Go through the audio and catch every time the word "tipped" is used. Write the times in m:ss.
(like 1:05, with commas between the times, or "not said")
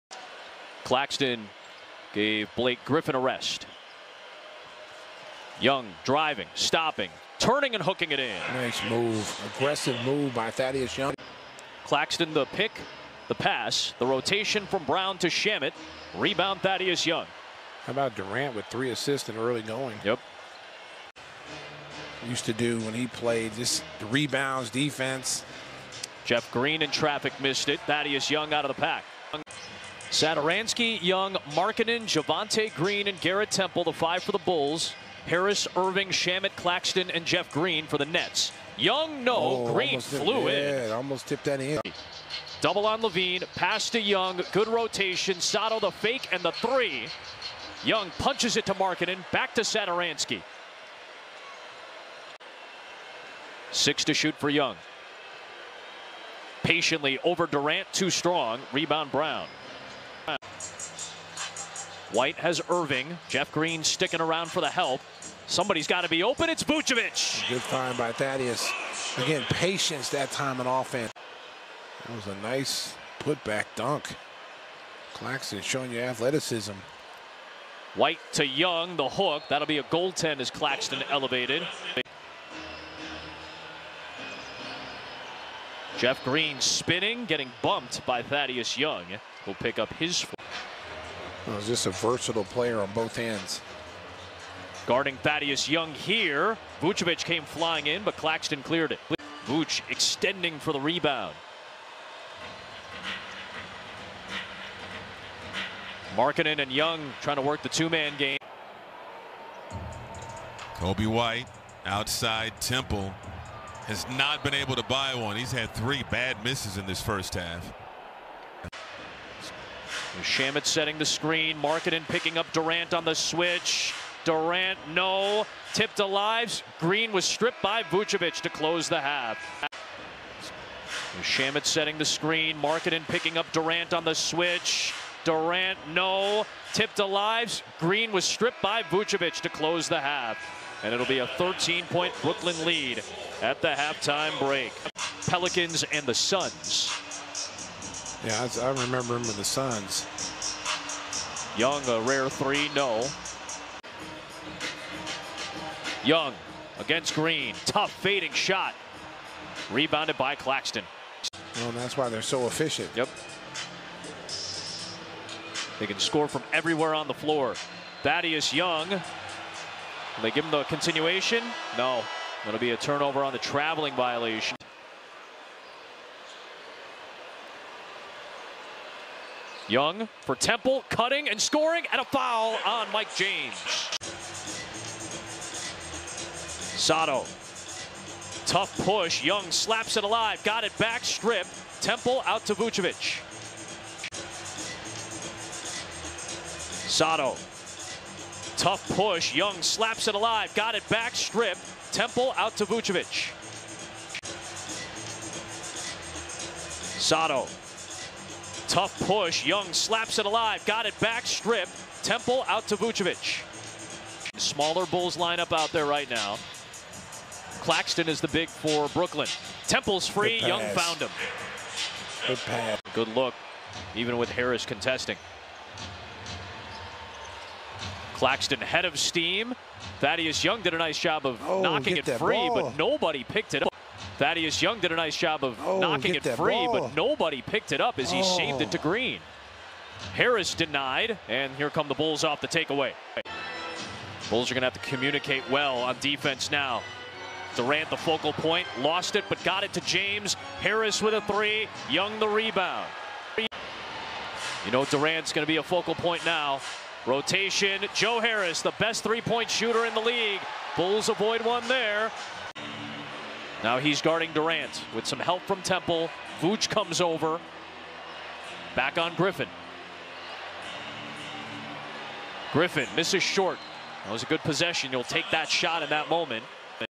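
0:41, 2:05, 2:16.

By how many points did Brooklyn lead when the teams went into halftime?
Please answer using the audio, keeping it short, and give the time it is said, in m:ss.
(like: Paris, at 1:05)
13, at 2:21.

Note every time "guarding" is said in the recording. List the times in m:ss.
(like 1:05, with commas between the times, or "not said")
1:34, 4:24.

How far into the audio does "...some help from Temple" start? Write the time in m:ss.
4:25.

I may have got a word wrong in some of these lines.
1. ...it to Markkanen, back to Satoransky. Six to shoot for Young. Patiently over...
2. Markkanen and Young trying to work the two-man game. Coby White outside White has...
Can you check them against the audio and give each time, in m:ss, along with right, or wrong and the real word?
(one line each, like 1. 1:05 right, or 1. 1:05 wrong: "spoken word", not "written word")
1. 0:48 right
2. 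1:46 wrong: "Temple", not "White".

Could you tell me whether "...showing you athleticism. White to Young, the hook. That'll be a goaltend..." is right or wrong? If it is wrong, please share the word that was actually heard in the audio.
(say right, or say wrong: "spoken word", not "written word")
right.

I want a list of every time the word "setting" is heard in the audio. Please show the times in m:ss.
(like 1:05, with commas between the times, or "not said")
2:00, 2:11.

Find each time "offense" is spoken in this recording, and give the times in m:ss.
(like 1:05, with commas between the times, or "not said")
1:10.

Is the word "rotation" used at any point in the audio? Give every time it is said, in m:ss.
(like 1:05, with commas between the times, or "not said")
0:14, 0:44, 4:17.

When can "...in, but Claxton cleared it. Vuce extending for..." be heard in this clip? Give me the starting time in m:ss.
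1:37.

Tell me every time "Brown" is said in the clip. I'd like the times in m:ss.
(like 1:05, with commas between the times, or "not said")
0:14, 0:59.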